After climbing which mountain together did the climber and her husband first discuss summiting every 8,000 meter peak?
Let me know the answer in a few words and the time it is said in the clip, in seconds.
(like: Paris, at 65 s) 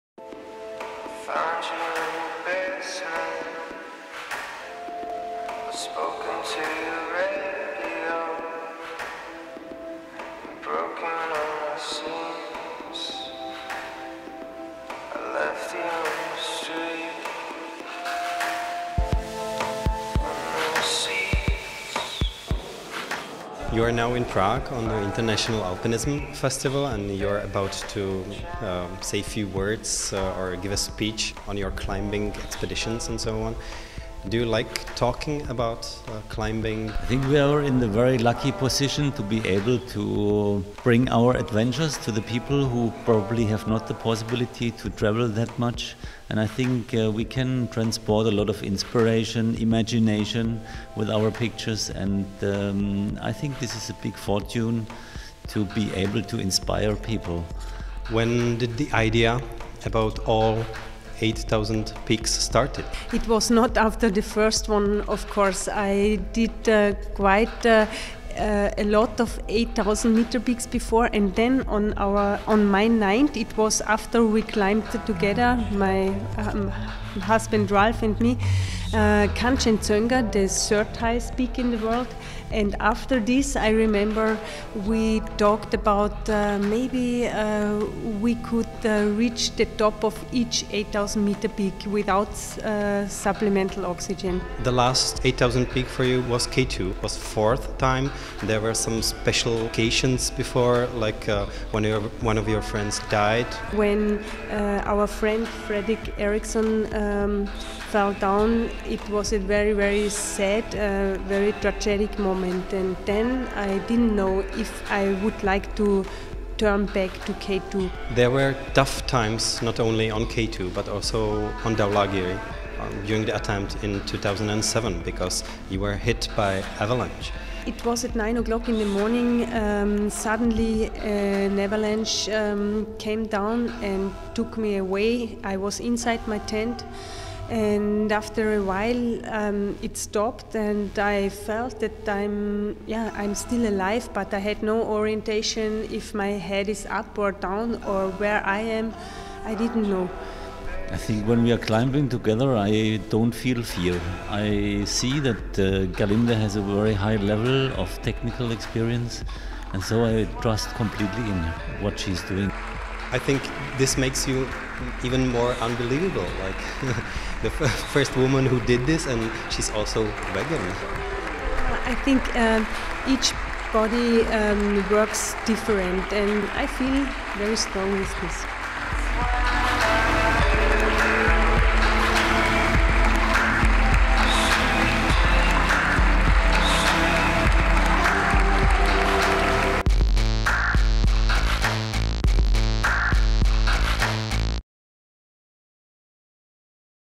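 Kanchenjunga, at 79 s.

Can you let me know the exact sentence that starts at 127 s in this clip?
It was at 9 o'clock in the morning.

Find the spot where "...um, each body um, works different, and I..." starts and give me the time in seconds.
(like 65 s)
172 s.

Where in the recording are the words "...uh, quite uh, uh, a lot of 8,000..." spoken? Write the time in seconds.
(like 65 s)
66 s.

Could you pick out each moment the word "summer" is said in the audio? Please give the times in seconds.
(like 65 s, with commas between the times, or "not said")
not said.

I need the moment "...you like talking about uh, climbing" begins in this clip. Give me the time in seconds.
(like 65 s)
34 s.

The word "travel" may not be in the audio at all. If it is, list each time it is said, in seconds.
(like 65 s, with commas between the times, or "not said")
44 s.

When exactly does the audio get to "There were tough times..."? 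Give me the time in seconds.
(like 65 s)
118 s.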